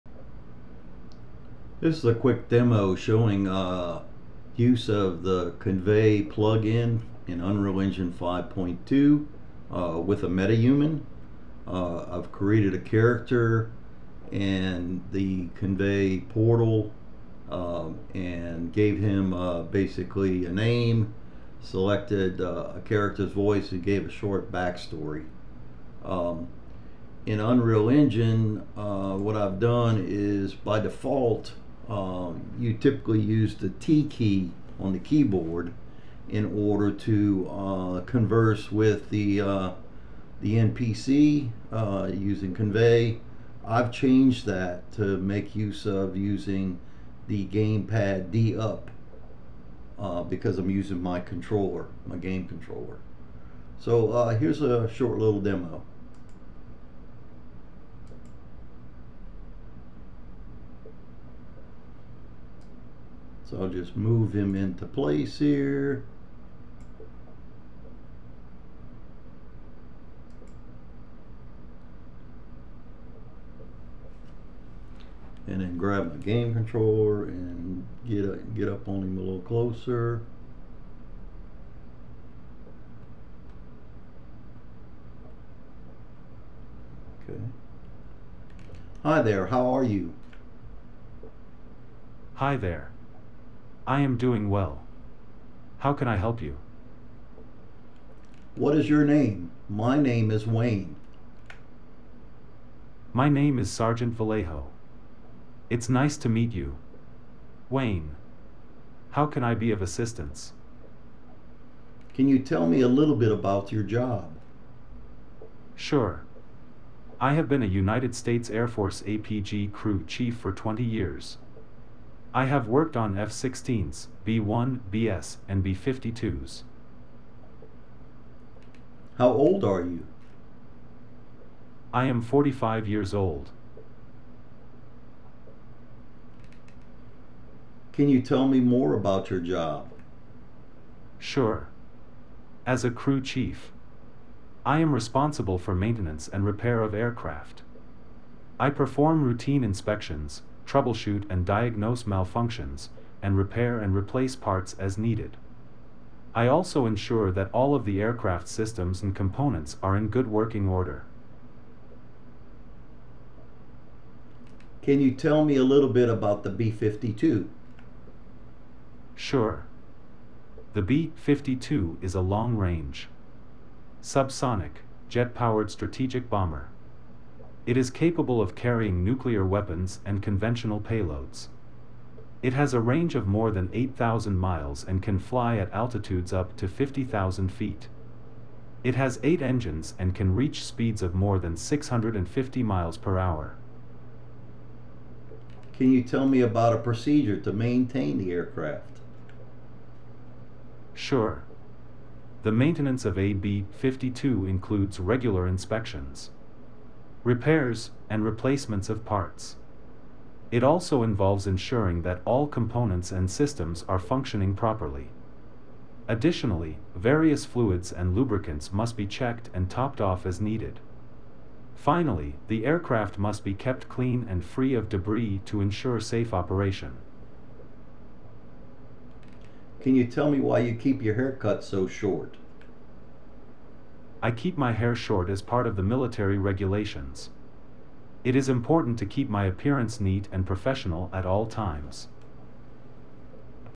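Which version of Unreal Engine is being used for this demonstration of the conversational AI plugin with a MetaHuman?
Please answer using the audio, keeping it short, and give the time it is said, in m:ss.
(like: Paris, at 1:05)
5.2, at 0:08.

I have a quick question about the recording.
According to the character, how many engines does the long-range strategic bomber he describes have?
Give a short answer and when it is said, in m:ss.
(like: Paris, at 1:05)
8, at 3:09.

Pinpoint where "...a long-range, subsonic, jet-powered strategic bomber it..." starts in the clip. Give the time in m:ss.
2:52.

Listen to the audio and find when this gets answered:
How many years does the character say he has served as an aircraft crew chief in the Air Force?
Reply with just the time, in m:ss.
2:00.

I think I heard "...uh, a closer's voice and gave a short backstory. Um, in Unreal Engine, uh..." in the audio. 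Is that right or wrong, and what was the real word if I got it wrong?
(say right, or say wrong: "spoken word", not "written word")
wrong: "character", not "closer".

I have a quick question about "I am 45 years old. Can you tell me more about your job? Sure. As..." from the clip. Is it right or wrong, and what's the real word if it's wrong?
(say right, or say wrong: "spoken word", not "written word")
right.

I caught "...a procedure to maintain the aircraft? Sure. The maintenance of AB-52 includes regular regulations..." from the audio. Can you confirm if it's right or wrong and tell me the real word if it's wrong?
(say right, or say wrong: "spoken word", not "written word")
wrong: "inspections", not "regulations".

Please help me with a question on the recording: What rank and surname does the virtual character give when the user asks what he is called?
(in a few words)
Sergeant Vallejo.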